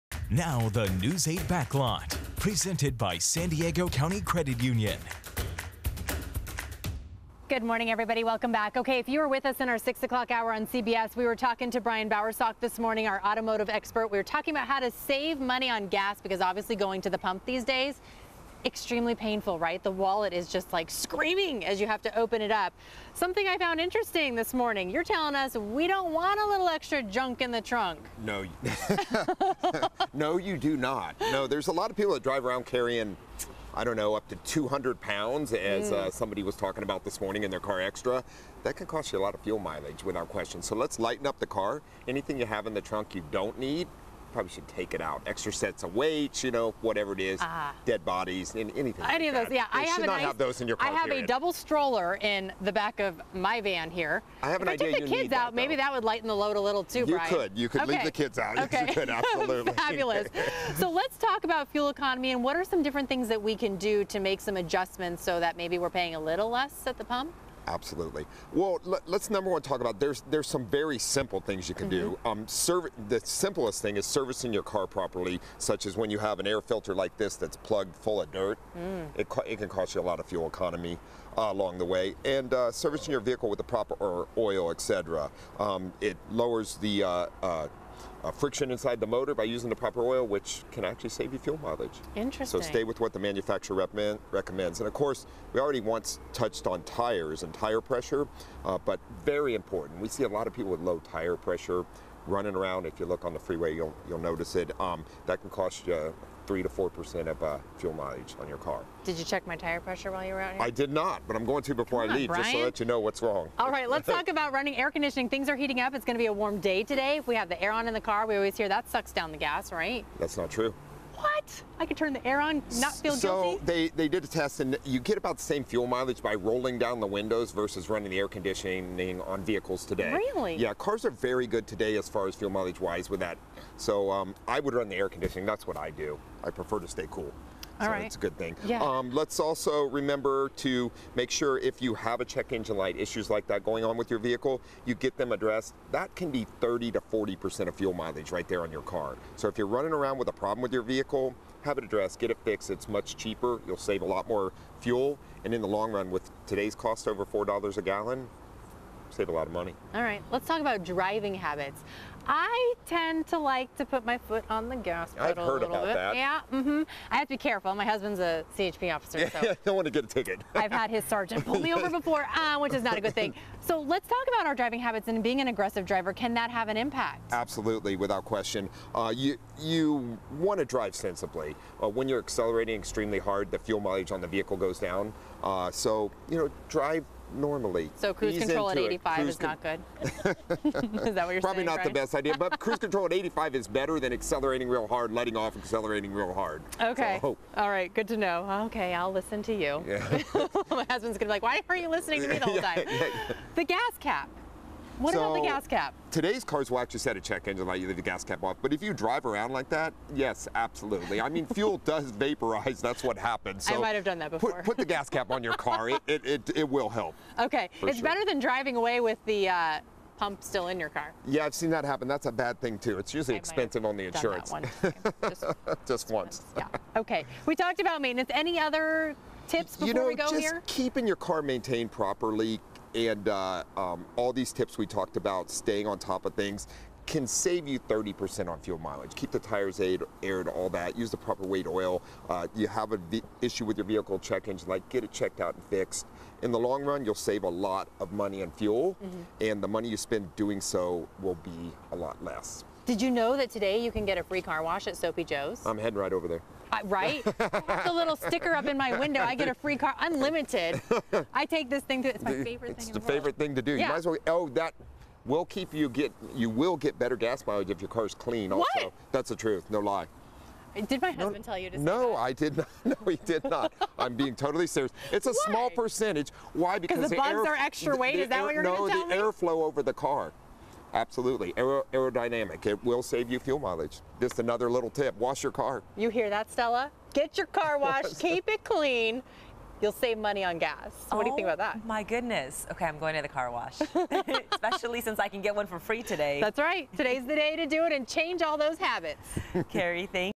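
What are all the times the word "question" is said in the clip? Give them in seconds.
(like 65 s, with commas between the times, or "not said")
40 s, 178 s.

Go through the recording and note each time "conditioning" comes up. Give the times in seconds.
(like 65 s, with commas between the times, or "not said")
114 s, 128 s, 135 s.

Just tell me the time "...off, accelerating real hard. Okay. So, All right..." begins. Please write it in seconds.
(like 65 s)
195 s.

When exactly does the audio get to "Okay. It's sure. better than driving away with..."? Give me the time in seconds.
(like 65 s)
217 s.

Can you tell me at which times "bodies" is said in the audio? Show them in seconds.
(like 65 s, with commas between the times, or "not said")
48 s.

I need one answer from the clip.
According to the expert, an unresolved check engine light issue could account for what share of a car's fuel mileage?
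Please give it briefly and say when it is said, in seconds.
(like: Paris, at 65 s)
30 to 40%, at 146 s.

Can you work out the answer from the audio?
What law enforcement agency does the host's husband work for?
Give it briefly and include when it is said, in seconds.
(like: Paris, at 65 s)
CHP, at 168 s.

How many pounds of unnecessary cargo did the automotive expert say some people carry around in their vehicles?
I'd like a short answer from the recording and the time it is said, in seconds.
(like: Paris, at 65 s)
200, at 34 s.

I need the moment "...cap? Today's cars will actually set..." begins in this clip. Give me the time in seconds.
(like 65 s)
205 s.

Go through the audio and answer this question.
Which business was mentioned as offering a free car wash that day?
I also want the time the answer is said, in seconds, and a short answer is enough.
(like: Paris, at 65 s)
Soapy Joe's, at 254 s.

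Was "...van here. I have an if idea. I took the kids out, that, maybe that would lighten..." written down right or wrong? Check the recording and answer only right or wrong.
right.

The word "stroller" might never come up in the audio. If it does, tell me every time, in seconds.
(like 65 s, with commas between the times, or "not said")
51 s.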